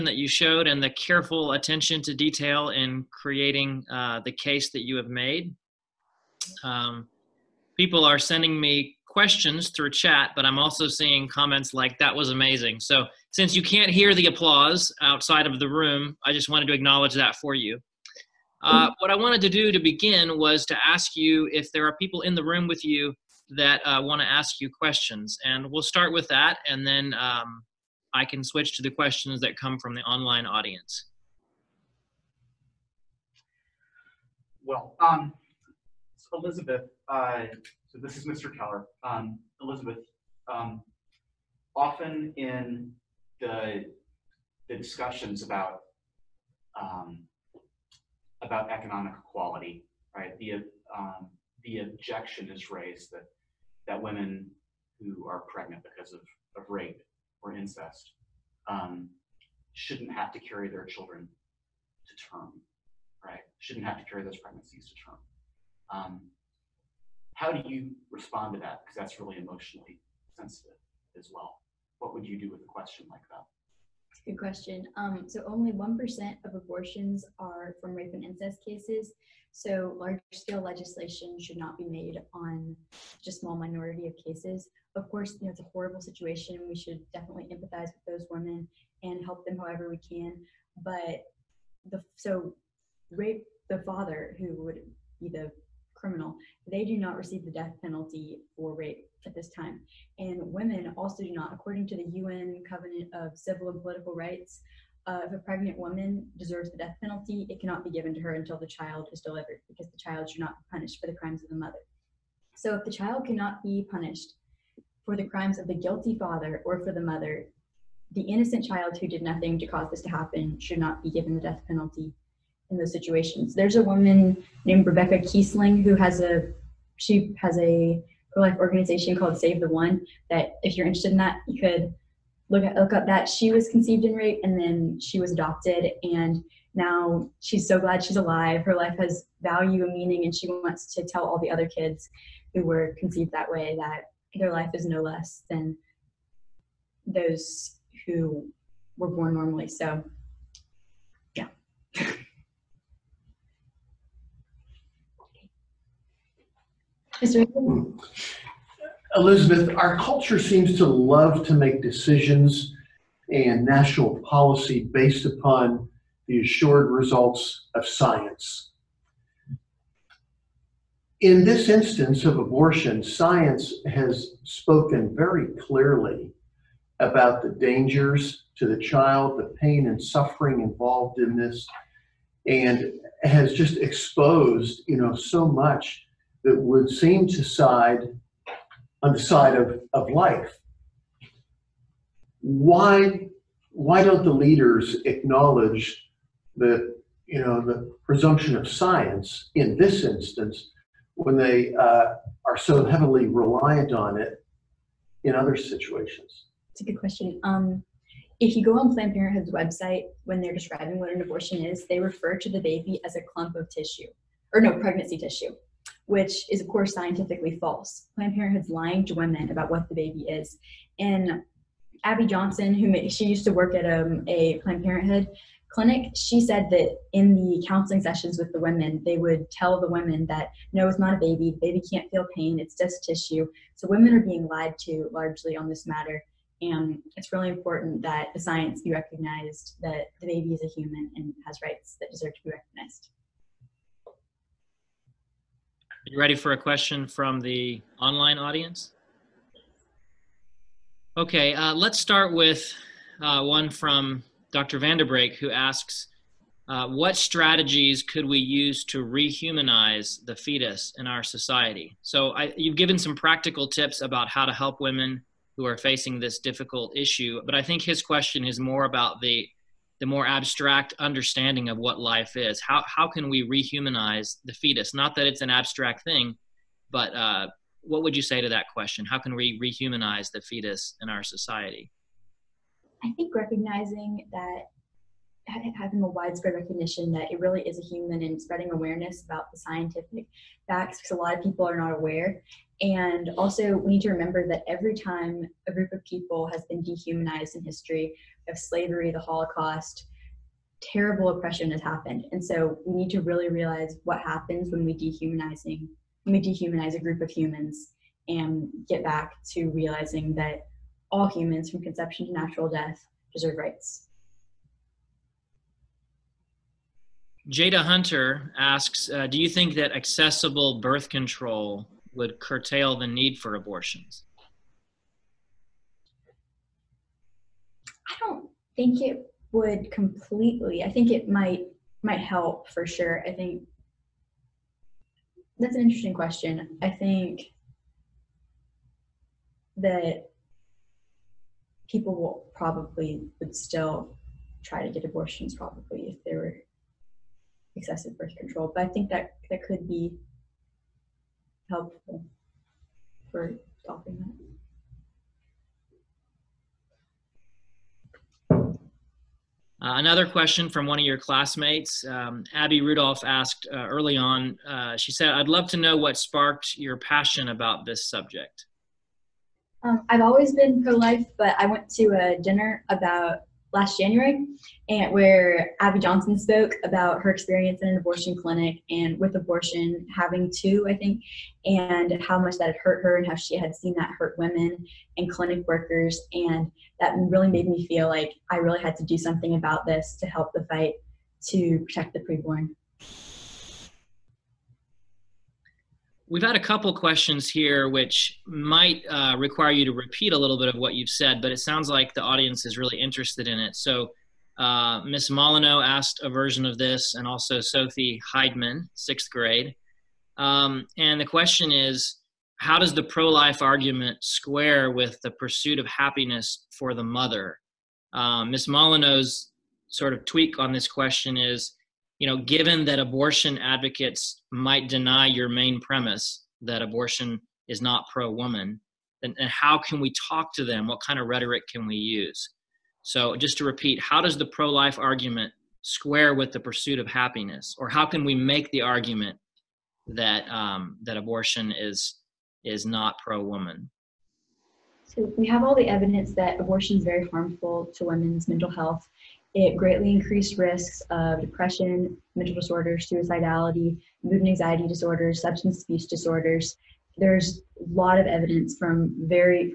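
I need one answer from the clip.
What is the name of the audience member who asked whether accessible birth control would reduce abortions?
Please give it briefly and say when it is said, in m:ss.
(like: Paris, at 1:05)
Jada Hunter, at 5:17.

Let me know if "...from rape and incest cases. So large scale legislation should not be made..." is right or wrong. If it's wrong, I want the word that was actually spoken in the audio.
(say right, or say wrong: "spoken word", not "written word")
right.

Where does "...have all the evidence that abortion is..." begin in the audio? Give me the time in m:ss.
7:25.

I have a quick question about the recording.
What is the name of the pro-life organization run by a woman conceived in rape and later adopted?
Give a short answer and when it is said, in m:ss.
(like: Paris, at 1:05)
Save the One, at 2:09.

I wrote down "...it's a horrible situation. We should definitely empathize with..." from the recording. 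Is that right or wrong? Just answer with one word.
right.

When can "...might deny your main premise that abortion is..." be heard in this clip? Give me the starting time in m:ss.
7:04.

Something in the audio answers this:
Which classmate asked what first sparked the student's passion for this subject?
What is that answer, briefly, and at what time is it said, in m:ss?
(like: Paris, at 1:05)
Abby Rudolph, at 6:02.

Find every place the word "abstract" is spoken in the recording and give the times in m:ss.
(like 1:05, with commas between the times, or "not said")
4:30, 4:35.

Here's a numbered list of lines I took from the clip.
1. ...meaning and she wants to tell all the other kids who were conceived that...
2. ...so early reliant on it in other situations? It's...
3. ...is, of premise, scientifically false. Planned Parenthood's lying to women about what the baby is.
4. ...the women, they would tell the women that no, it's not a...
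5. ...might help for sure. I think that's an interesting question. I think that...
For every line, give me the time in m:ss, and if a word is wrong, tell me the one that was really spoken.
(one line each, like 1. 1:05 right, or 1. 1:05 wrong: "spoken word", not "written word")
1. 2:19 right
2. 3:22 wrong: "heavily", not "early"
3. 3:36 wrong: "course", not "premise"
4. 3:48 right
5. 5:32 right.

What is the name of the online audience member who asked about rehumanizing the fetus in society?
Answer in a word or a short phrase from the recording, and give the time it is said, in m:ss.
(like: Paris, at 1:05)
Dr. Vanderbreek, at 4:14.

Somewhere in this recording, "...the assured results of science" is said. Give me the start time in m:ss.
2:46.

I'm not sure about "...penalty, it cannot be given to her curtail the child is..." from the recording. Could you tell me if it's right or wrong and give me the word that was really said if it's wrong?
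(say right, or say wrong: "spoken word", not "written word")
wrong: "until", not "curtail".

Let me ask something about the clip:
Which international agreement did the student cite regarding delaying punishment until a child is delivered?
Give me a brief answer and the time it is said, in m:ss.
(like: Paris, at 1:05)
UN Covenant of Civil and Political Rights, at 1:42.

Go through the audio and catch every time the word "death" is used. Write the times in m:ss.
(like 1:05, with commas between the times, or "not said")
1:37, 1:46, 2:01, 5:12.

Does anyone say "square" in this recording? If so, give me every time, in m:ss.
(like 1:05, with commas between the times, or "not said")
6:54, 7:15.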